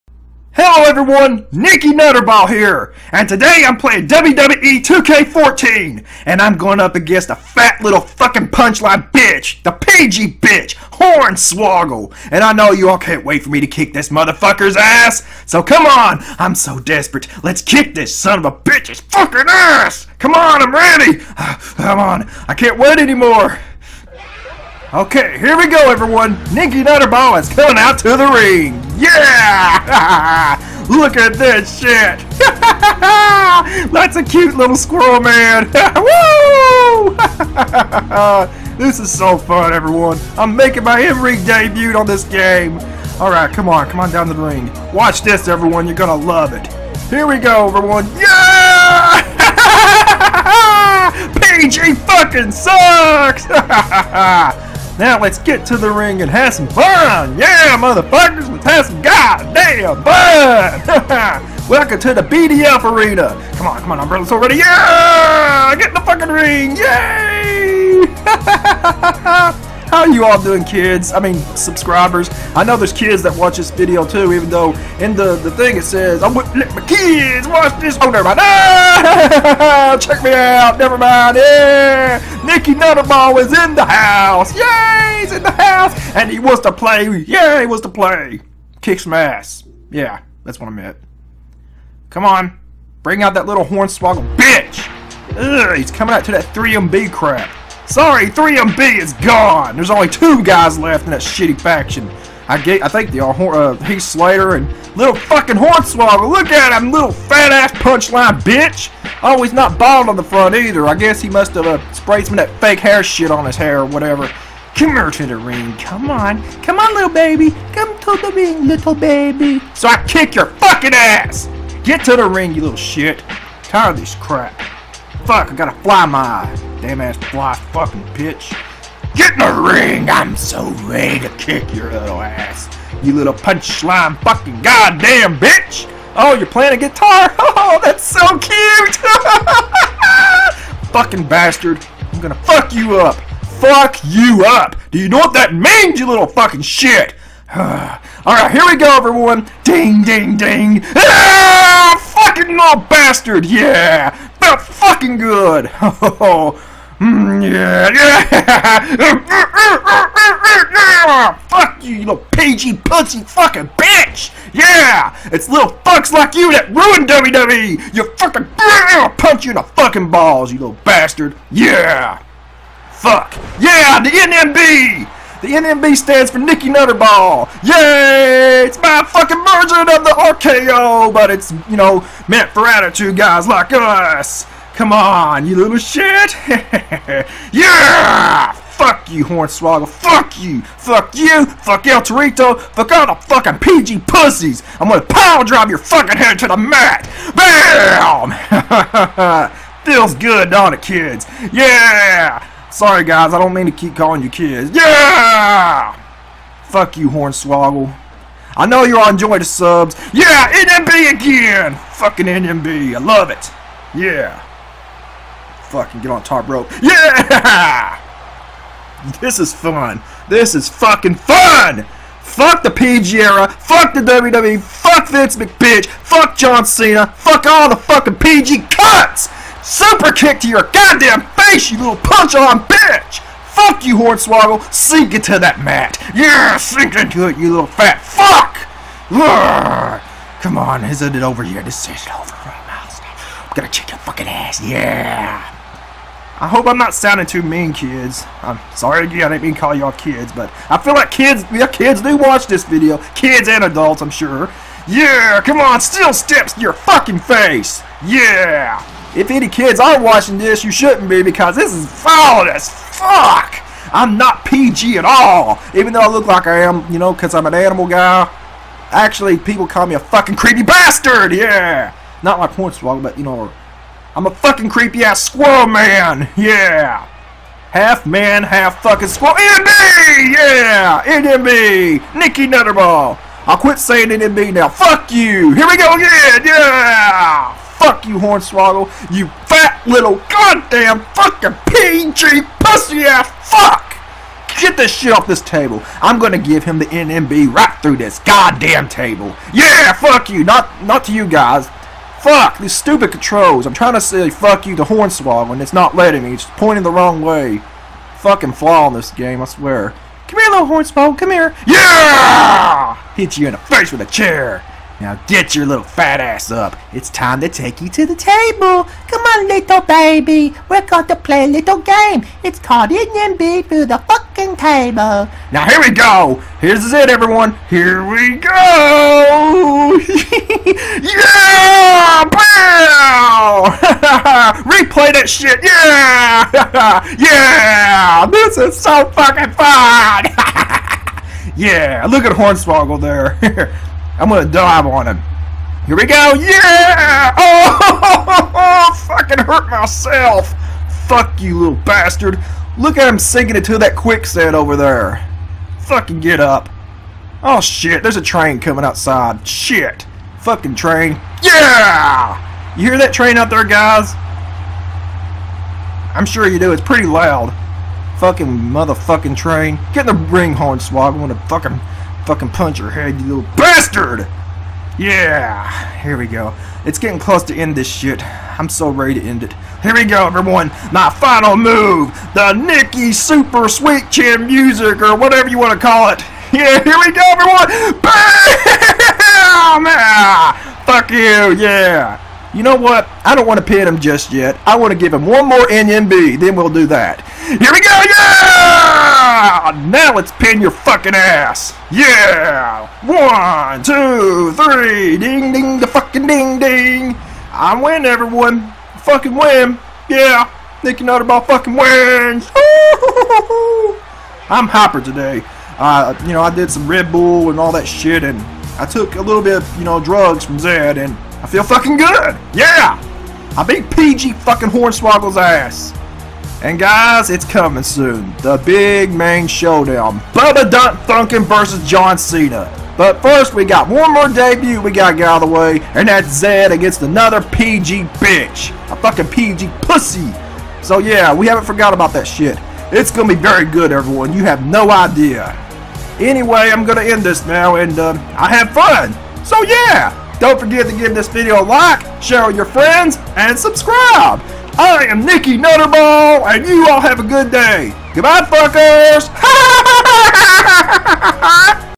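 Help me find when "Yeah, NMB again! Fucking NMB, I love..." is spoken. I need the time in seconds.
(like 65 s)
210 s.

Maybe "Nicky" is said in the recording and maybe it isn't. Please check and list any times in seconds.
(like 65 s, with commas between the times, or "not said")
1 s, 26 s, 82 s, 176 s, 282 s, 382 s, 410 s, 455 s.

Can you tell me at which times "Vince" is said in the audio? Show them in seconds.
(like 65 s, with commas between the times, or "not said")
225 s.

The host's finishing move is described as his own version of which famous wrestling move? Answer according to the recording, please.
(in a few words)
RKO.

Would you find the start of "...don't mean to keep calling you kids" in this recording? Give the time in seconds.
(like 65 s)
203 s.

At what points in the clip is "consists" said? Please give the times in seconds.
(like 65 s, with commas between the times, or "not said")
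not said.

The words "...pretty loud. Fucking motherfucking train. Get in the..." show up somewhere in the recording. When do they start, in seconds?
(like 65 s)
366 s.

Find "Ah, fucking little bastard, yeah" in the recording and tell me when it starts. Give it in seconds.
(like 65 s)
150 s.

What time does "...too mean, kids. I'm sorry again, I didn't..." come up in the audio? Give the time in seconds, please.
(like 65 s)
247 s.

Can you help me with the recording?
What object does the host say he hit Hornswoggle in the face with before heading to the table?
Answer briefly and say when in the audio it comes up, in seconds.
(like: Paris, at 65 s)
A chair, at 314 s.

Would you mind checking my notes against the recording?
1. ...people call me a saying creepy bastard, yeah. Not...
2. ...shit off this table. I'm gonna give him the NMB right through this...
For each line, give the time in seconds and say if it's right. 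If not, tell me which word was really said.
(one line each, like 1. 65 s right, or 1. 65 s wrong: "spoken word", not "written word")
1. 269 s wrong: "fucking", not "saying"
2. 294 s right.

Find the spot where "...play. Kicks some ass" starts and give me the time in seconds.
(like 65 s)
87 s.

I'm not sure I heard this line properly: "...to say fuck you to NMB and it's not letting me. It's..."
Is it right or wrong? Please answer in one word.
wrong.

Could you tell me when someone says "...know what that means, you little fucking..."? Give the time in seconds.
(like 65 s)
145 s.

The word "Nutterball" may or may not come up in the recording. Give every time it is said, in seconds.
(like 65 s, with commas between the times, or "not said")
1 s, 26 s, 82 s, 176 s, 282 s, 411 s, 455 s.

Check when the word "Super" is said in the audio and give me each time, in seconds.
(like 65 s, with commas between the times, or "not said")
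229 s, 383 s.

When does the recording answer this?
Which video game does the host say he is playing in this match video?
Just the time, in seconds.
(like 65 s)
4 s.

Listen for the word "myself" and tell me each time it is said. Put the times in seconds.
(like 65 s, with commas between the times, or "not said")
349 s.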